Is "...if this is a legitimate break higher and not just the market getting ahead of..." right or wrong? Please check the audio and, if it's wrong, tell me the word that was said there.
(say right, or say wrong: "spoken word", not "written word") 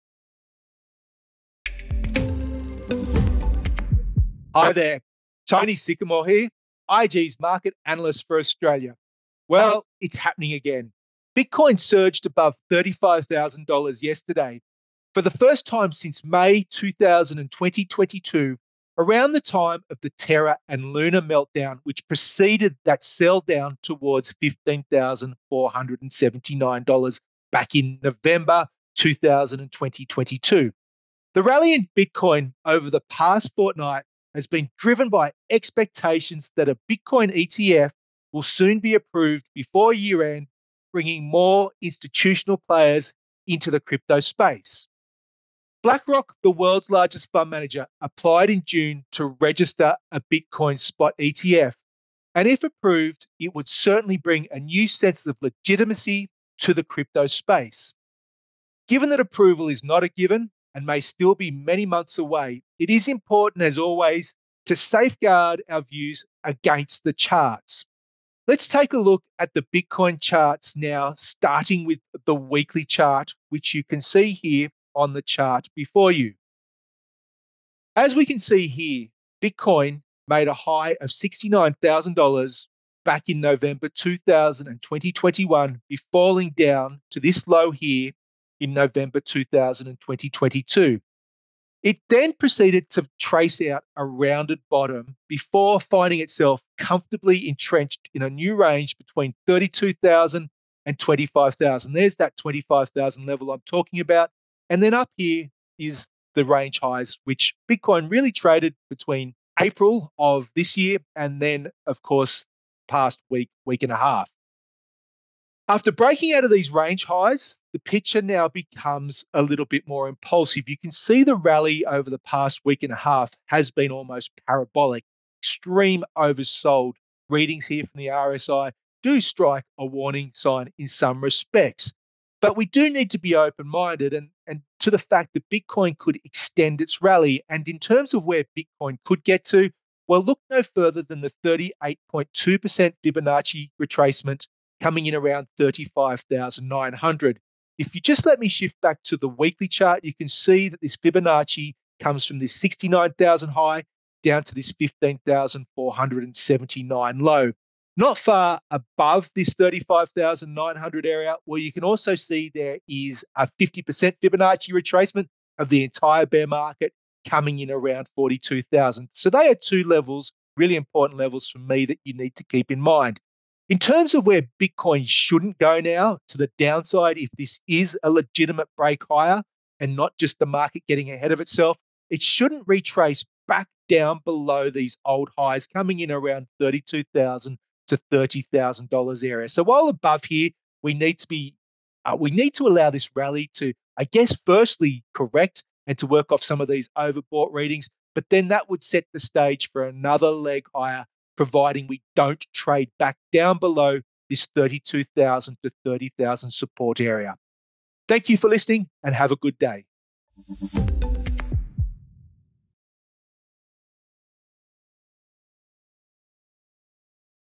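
right.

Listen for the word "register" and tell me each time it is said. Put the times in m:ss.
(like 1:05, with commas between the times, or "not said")
0:49.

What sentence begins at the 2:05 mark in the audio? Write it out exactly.
Extreme oversold readings here from the RSI do strike a warning sign in some respects.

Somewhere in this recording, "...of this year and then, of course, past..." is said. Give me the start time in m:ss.
1:50.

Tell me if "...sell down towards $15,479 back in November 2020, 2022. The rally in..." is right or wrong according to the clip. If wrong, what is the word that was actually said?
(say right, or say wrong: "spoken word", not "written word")
right.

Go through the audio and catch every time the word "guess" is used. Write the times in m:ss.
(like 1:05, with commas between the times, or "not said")
3:14.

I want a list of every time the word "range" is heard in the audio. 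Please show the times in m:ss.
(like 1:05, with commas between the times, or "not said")
1:38, 1:46, 1:56.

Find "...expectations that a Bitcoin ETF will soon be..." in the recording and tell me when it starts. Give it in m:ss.
0:35.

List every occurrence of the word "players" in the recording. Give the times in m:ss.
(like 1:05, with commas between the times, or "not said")
0:42.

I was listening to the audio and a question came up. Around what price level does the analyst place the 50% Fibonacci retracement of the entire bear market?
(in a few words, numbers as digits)
42,000.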